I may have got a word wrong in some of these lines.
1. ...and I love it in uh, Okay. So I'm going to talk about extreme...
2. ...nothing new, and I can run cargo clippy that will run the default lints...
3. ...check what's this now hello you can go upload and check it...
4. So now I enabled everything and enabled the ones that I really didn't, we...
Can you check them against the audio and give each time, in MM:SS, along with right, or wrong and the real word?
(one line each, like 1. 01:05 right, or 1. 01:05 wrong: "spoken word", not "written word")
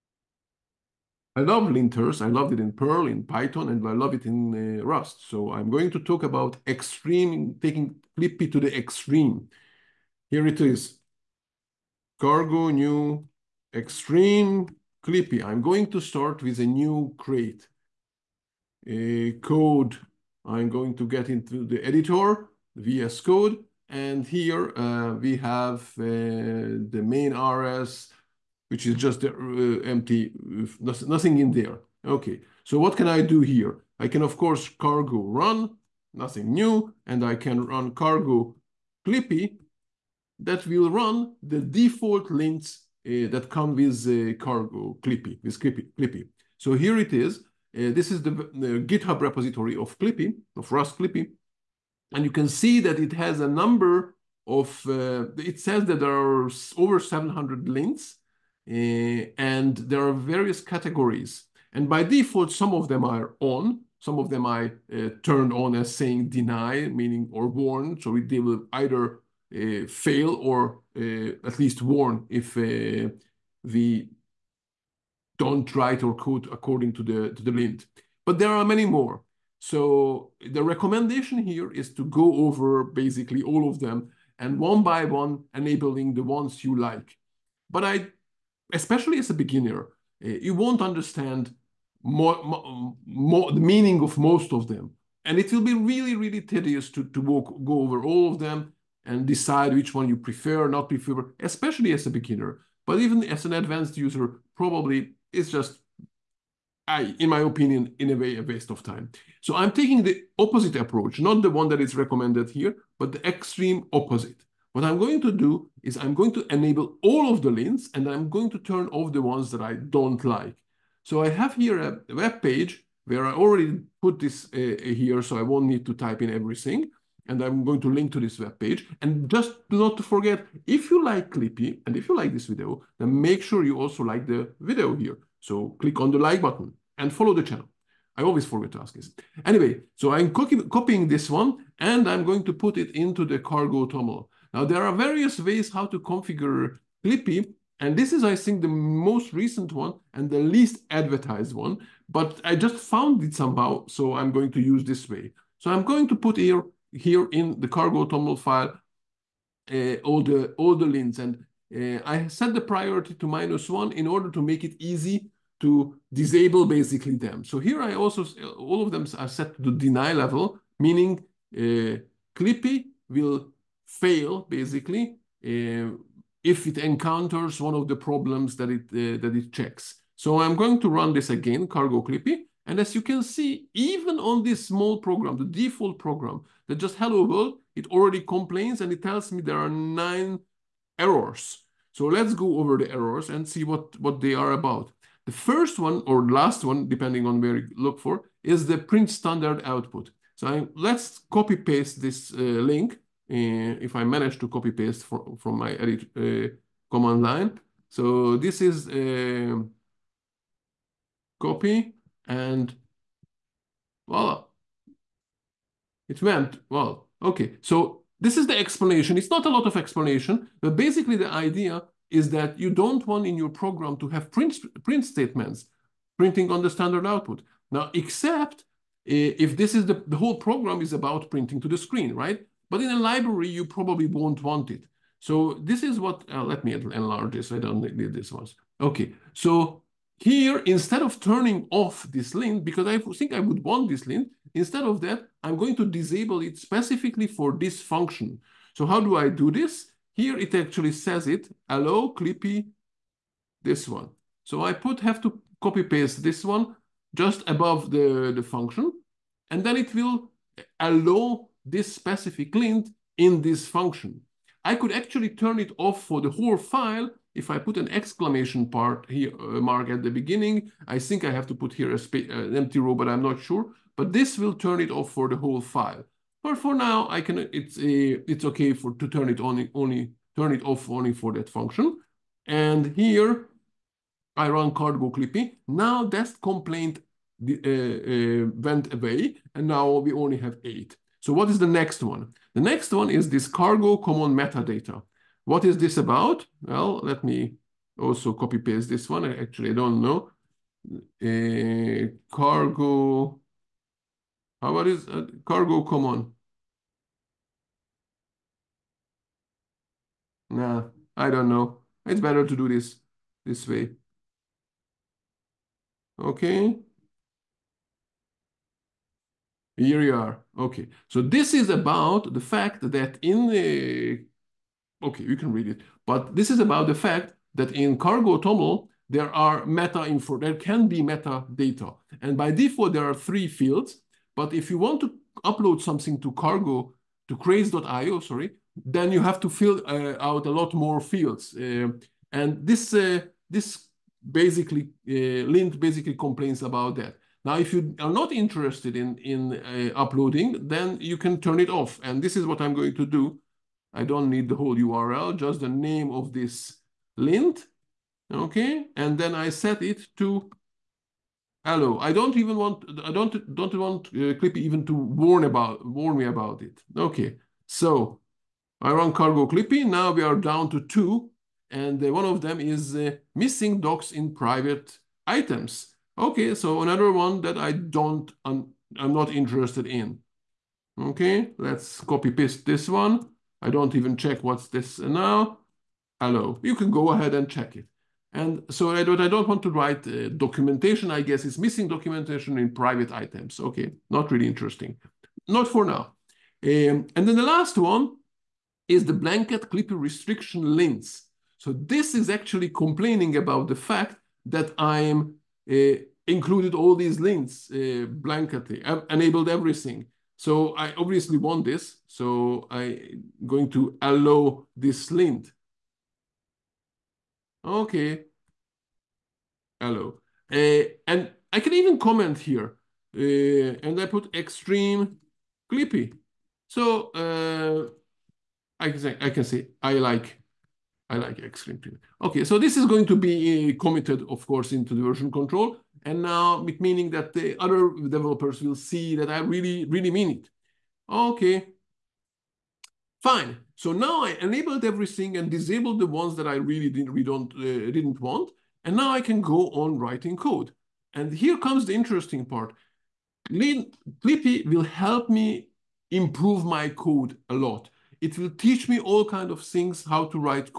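1. 00:03 wrong: "Rust", not "Okay"
2. 00:36 right
3. 06:24 wrong: "ahead", not "upload"
4. 07:23 wrong: "disabled", not "enabled".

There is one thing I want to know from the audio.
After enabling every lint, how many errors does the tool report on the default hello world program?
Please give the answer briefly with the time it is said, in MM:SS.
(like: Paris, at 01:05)
9, at 03:09.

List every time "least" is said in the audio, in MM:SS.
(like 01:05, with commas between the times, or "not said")
01:11, 02:30.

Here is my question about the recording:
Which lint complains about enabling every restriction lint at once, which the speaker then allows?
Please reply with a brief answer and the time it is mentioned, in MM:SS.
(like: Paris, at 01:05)
blanket clippy restriction lints, at 06:39.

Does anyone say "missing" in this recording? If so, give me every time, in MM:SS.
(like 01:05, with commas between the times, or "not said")
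06:13, 06:31.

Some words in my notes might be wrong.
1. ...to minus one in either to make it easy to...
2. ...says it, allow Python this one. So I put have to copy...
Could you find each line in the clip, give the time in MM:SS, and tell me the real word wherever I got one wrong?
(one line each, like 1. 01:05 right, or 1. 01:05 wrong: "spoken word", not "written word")
1. 02:43 wrong: "order", not "either"
2. 04:10 wrong: "Clippy", not "Python".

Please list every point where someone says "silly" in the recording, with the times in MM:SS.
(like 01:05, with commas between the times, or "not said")
not said.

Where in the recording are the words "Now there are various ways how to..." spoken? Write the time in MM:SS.
02:24.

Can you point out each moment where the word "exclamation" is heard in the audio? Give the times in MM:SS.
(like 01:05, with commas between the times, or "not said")
04:27.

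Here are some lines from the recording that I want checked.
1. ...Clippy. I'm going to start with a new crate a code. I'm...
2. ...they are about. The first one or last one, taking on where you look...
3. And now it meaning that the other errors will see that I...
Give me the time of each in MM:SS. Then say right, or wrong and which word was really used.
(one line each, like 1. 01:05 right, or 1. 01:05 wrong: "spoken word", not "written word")
1. 00:15 right
2. 03:14 wrong: "depending", not "taking"
3. 07:16 wrong: "developers", not "errors".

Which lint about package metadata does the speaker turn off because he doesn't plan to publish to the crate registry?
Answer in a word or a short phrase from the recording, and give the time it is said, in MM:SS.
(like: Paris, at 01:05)
cargo common metadata, at 04:53.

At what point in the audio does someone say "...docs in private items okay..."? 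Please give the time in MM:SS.
06:13.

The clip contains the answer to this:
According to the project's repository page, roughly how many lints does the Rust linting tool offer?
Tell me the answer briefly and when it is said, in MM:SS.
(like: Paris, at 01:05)
over 700, at 00:56.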